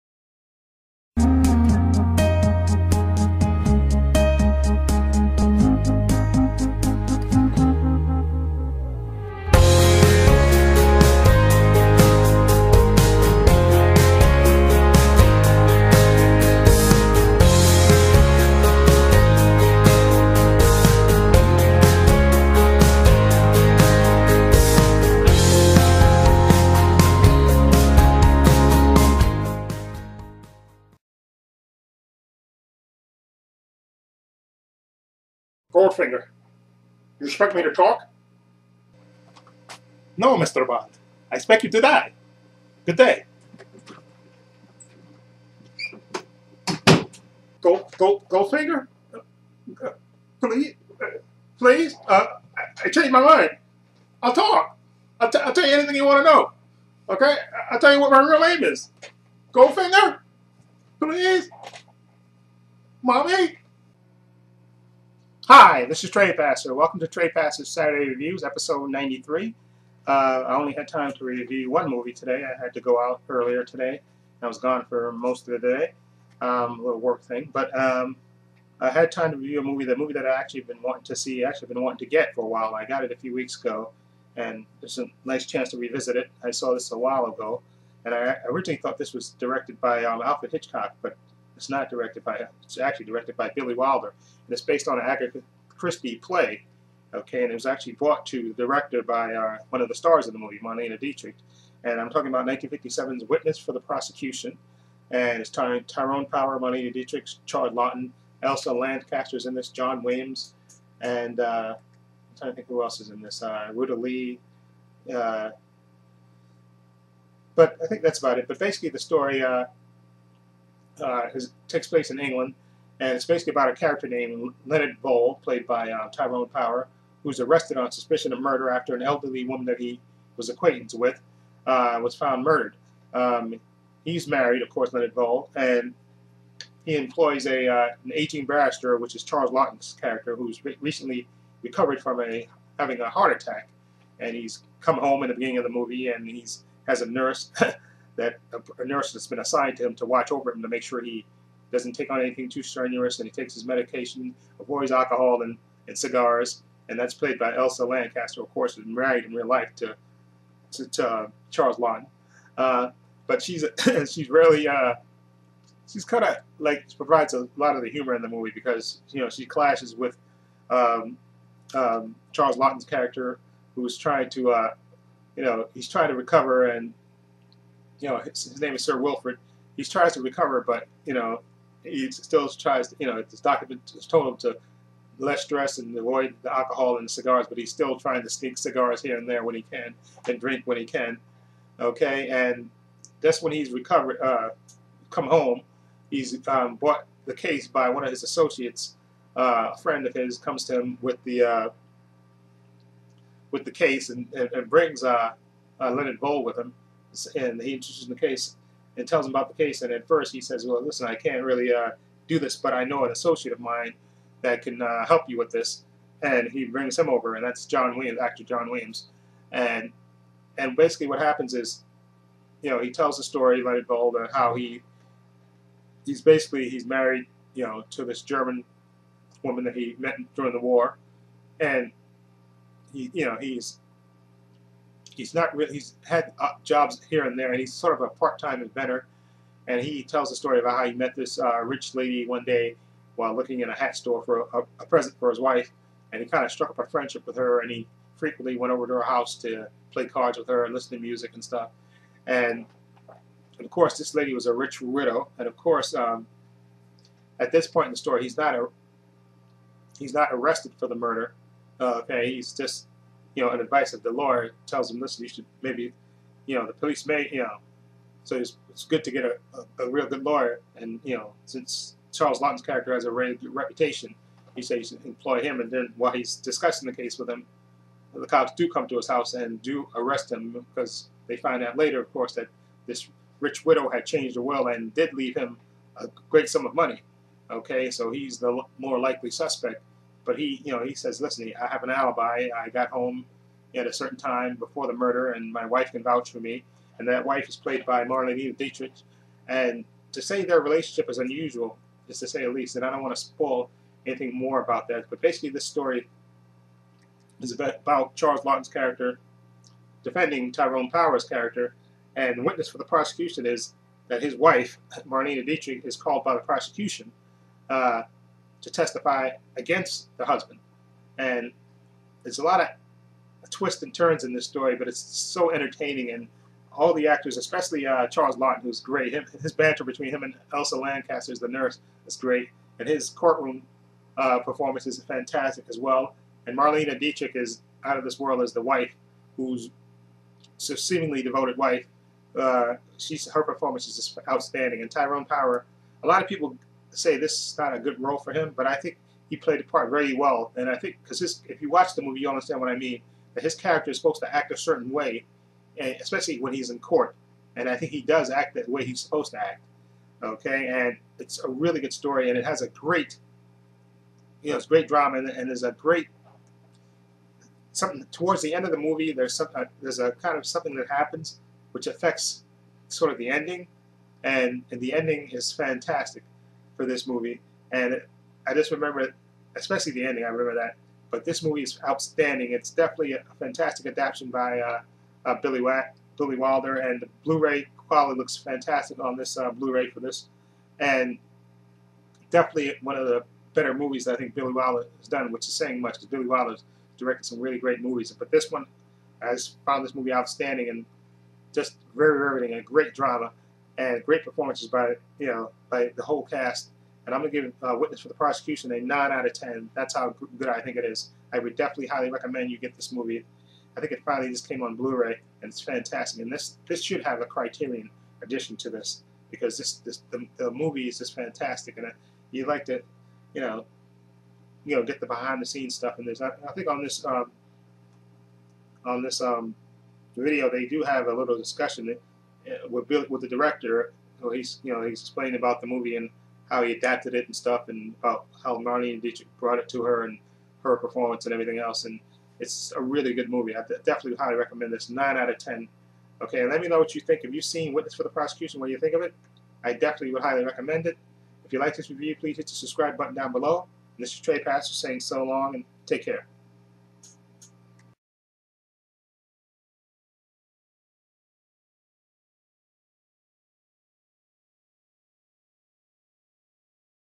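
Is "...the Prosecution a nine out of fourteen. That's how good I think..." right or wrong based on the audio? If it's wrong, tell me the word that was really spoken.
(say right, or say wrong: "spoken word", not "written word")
wrong: "ten", not "fourteen".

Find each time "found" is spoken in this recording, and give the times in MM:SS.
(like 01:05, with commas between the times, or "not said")
02:12, 06:39.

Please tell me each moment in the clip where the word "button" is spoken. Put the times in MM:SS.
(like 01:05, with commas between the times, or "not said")
07:32.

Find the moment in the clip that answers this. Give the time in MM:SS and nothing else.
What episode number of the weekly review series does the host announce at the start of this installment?
01:08.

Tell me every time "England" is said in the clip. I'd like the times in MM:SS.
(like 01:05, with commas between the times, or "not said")
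02:02.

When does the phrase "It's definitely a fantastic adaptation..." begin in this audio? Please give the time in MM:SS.
06:22.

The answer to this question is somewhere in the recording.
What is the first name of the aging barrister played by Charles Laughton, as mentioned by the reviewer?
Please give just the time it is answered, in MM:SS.
02:58.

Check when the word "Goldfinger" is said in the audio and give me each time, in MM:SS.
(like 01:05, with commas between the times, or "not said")
00:35, 00:48, 00:59.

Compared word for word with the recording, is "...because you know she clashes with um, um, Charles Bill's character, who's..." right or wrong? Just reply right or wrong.
wrong.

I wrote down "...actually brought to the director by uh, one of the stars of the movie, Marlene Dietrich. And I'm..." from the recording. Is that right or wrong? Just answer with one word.
right.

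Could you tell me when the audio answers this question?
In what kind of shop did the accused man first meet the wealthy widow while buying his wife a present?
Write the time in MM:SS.
04:03.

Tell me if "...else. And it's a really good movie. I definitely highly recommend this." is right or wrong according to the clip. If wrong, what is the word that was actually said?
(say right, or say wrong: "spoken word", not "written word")
right.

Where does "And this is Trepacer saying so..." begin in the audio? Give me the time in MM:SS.
07:33.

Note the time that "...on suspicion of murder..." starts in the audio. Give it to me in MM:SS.
02:07.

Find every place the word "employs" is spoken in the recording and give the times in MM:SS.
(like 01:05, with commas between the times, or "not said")
02:16, 04:35.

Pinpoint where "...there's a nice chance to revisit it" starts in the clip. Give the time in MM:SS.
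01:24.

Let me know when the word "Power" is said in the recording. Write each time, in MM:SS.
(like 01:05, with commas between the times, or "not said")
01:46, 02:06, 05:10, 05:45.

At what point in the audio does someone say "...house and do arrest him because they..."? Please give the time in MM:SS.
04:39.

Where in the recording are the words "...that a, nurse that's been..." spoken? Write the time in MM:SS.
02:28.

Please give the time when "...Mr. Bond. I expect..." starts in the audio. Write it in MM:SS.
00:40.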